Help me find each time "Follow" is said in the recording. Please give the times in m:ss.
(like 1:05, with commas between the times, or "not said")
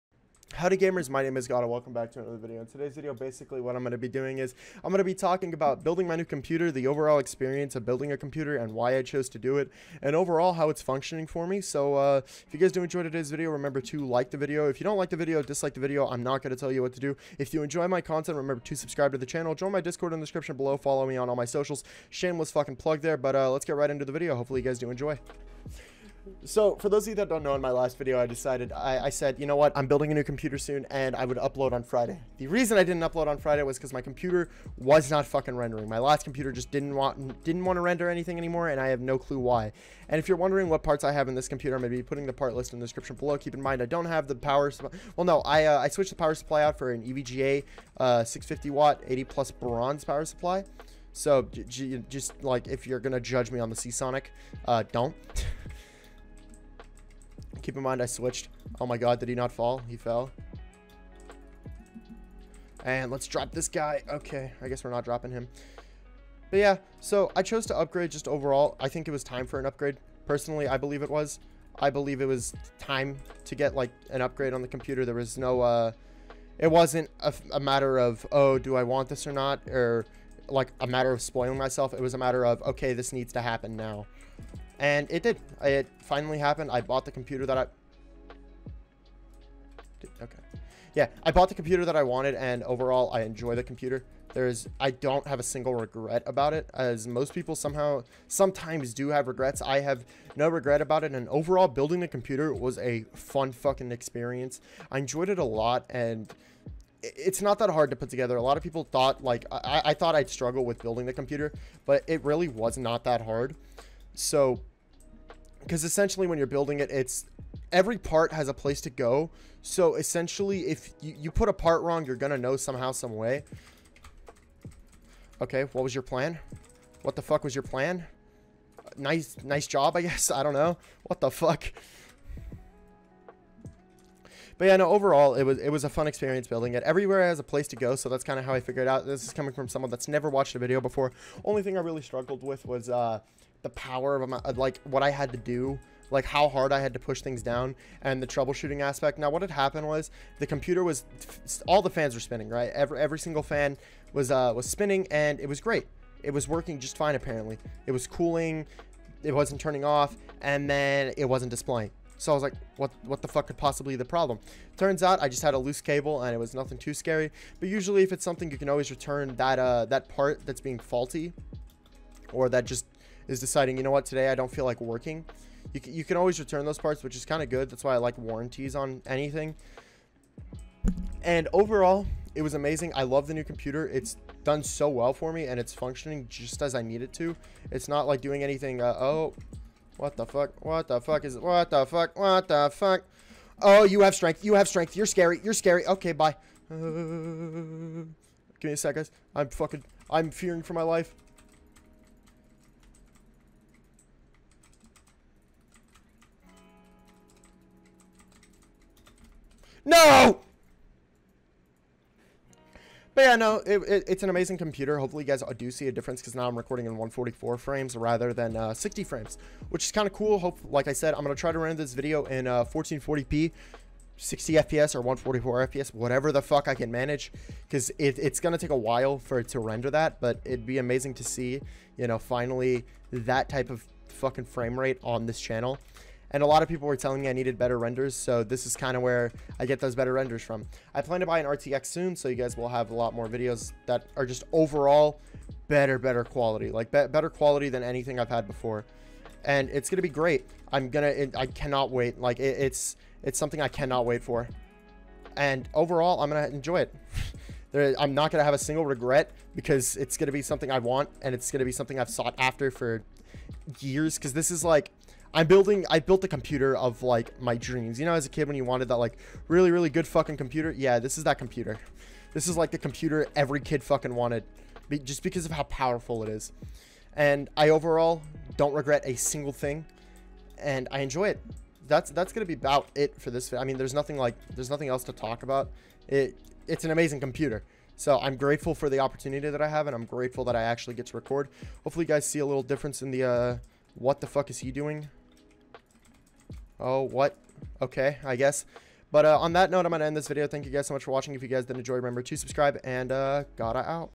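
0:20.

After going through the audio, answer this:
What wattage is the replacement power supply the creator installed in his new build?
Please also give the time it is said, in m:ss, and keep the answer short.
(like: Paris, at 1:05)
650 watt, at 0:48.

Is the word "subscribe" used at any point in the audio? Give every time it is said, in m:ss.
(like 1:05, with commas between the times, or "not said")
0:18, 5:02.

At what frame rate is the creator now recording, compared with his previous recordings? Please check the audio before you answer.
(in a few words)
144.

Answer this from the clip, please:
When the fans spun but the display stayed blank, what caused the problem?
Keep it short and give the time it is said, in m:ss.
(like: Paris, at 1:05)
A loose cable, at 2:45.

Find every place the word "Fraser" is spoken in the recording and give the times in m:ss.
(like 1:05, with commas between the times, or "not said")
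not said.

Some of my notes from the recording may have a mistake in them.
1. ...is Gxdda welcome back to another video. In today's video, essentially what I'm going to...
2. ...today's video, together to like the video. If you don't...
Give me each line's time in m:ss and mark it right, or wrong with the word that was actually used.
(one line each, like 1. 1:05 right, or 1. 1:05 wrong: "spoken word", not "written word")
1. 0:01 wrong: "basically", not "essentially"
2. 0:13 wrong: "remember", not "together".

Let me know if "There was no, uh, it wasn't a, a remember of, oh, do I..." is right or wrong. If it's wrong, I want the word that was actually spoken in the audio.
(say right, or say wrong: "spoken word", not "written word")
wrong: "matter", not "remember".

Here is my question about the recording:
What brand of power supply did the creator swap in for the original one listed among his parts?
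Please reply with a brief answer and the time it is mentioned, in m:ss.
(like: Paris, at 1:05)
EVGA, at 0:47.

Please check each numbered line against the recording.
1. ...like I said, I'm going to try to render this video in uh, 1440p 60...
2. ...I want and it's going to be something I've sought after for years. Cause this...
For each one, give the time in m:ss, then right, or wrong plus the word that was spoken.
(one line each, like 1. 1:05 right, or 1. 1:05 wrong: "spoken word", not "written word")
1. 3:40 right
2. 4:20 right.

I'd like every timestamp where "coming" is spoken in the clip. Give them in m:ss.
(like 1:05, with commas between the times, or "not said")
2:19.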